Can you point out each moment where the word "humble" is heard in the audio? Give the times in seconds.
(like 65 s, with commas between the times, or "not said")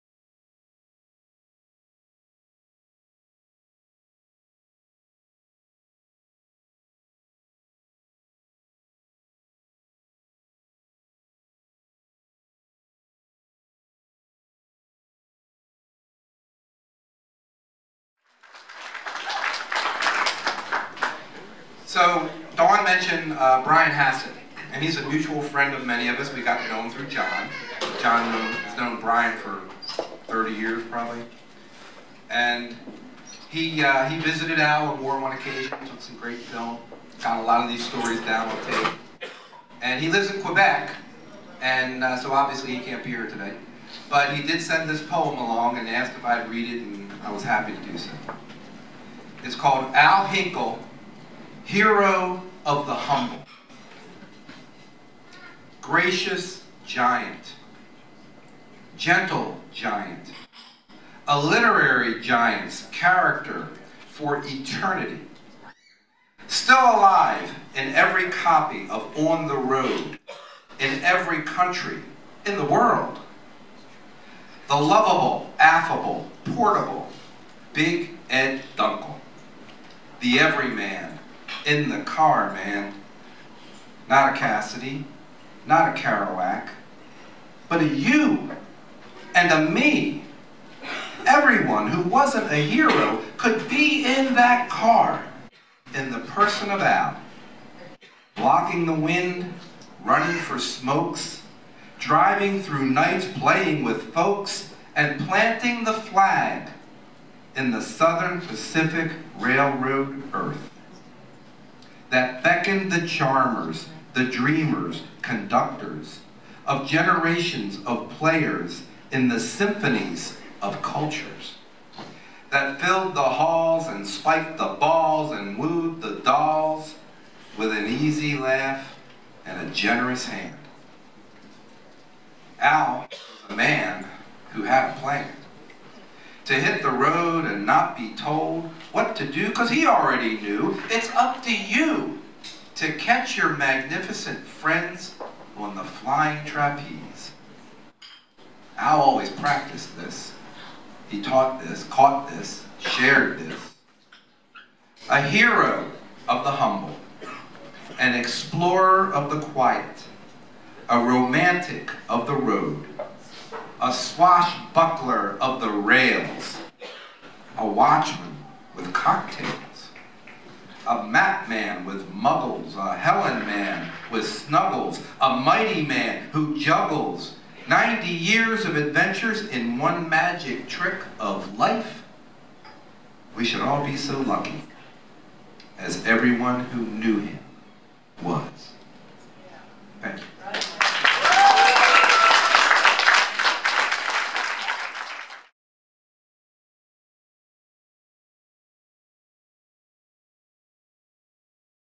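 52 s, 156 s.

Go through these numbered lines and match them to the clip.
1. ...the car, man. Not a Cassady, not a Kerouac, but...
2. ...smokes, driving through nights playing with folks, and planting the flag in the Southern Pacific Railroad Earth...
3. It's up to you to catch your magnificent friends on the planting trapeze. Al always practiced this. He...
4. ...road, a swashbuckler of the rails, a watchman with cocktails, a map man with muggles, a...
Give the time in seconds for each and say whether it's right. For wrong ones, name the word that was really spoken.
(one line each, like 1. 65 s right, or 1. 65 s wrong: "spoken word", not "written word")
1. 81 s right
2. 100 s right
3. 140 s wrong: "flying", not "planting"
4. 162 s right.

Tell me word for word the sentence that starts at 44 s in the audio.
But he did send this poem along and asked if I'd read it, and I was happy to do so.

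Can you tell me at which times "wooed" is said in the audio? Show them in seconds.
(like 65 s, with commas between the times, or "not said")
125 s.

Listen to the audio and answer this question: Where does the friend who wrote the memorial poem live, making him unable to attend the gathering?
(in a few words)
Quebec.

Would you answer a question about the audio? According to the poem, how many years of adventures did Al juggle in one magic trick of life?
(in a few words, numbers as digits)
90.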